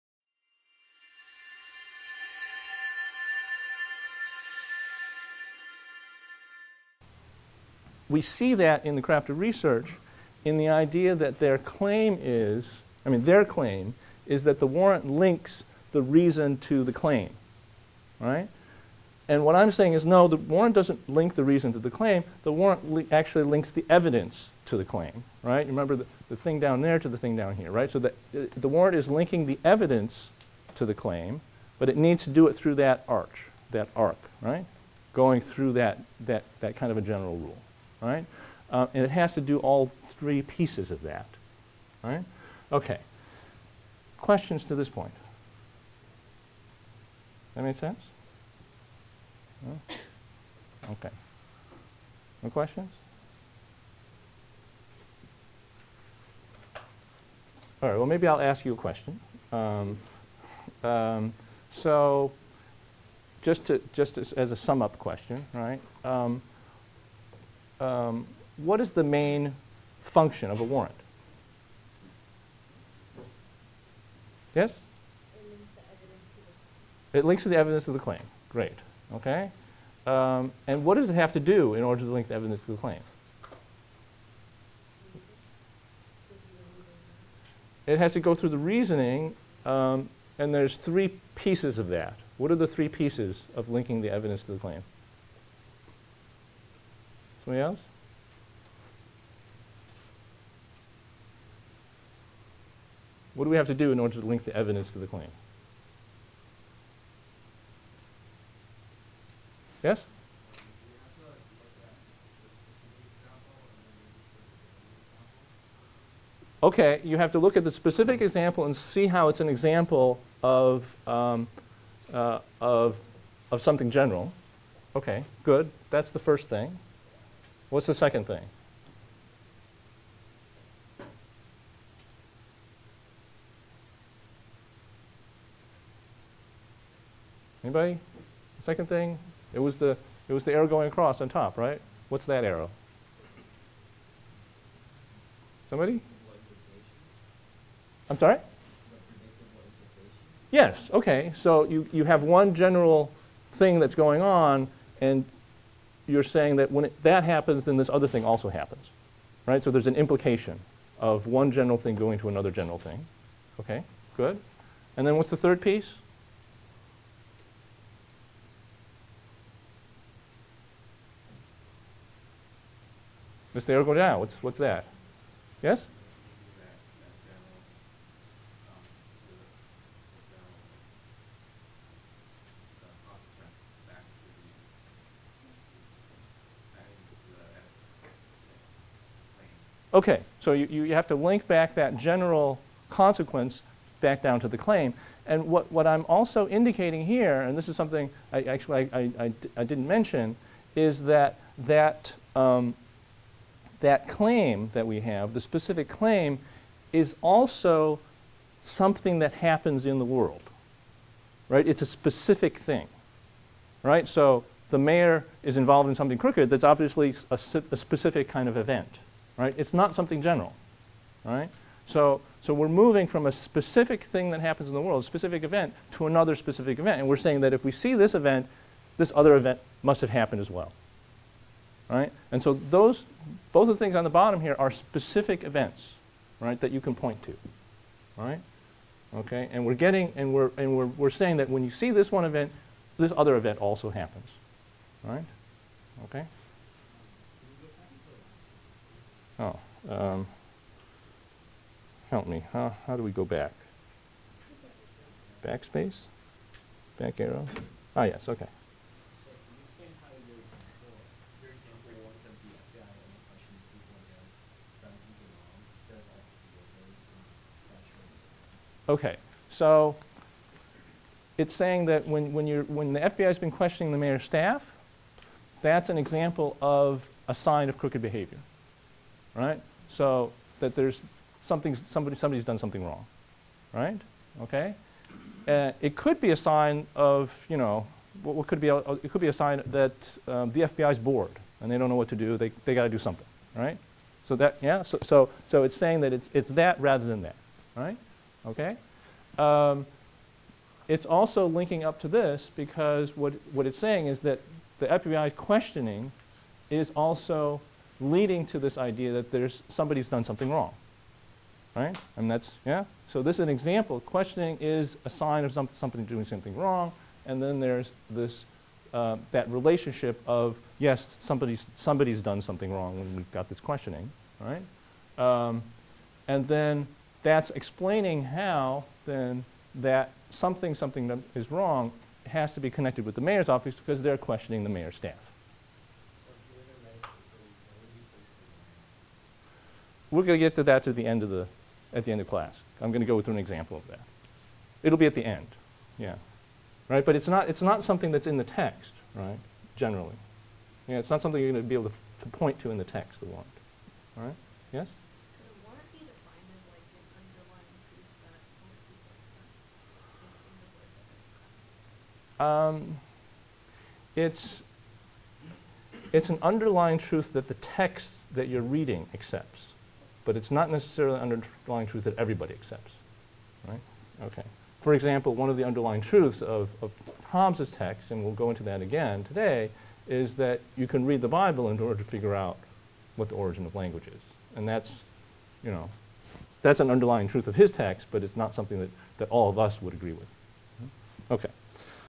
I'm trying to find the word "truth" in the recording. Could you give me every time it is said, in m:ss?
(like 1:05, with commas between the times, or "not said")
6:06, 6:11, 6:16, 6:27.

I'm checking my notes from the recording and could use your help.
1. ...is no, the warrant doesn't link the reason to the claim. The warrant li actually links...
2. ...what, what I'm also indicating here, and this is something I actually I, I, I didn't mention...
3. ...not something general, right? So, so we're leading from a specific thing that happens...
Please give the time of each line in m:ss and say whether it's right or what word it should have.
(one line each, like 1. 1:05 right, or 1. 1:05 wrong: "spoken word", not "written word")
1. 0:19 right
2. 3:15 right
3. 3:39 wrong: "moving", not "leading".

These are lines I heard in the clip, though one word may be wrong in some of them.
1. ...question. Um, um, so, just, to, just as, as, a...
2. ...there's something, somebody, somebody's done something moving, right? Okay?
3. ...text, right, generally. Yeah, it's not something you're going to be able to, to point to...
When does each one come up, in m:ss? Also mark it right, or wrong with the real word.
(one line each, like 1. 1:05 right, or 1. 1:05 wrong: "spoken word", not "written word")
1. 0:58 right
2. 4:40 wrong: "wrong", not "moving"
3. 5:48 right.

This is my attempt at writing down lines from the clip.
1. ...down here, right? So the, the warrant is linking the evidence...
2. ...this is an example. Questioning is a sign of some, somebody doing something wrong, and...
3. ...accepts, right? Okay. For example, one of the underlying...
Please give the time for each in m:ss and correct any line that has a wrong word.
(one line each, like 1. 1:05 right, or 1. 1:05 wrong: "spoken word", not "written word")
1. 0:27 right
2. 5:13 right
3. 6:12 right.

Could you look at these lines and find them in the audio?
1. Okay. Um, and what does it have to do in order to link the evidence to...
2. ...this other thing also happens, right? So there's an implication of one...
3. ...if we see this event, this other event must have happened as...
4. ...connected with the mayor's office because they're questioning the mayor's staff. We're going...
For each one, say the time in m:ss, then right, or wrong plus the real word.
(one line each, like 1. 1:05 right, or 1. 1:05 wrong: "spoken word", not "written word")
1. 1:19 right
2. 2:37 right
3. 3:47 right
4. 5:32 right.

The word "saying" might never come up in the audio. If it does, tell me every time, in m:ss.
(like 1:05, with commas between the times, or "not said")
0:19, 2:36, 3:47, 4:01, 4:55, 5:03.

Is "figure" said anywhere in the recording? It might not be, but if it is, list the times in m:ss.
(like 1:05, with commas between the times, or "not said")
6:22.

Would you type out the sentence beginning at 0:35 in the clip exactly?
Going through that, that, that kind of a general rule.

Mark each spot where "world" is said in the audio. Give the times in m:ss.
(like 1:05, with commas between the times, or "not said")
3:30, 3:44.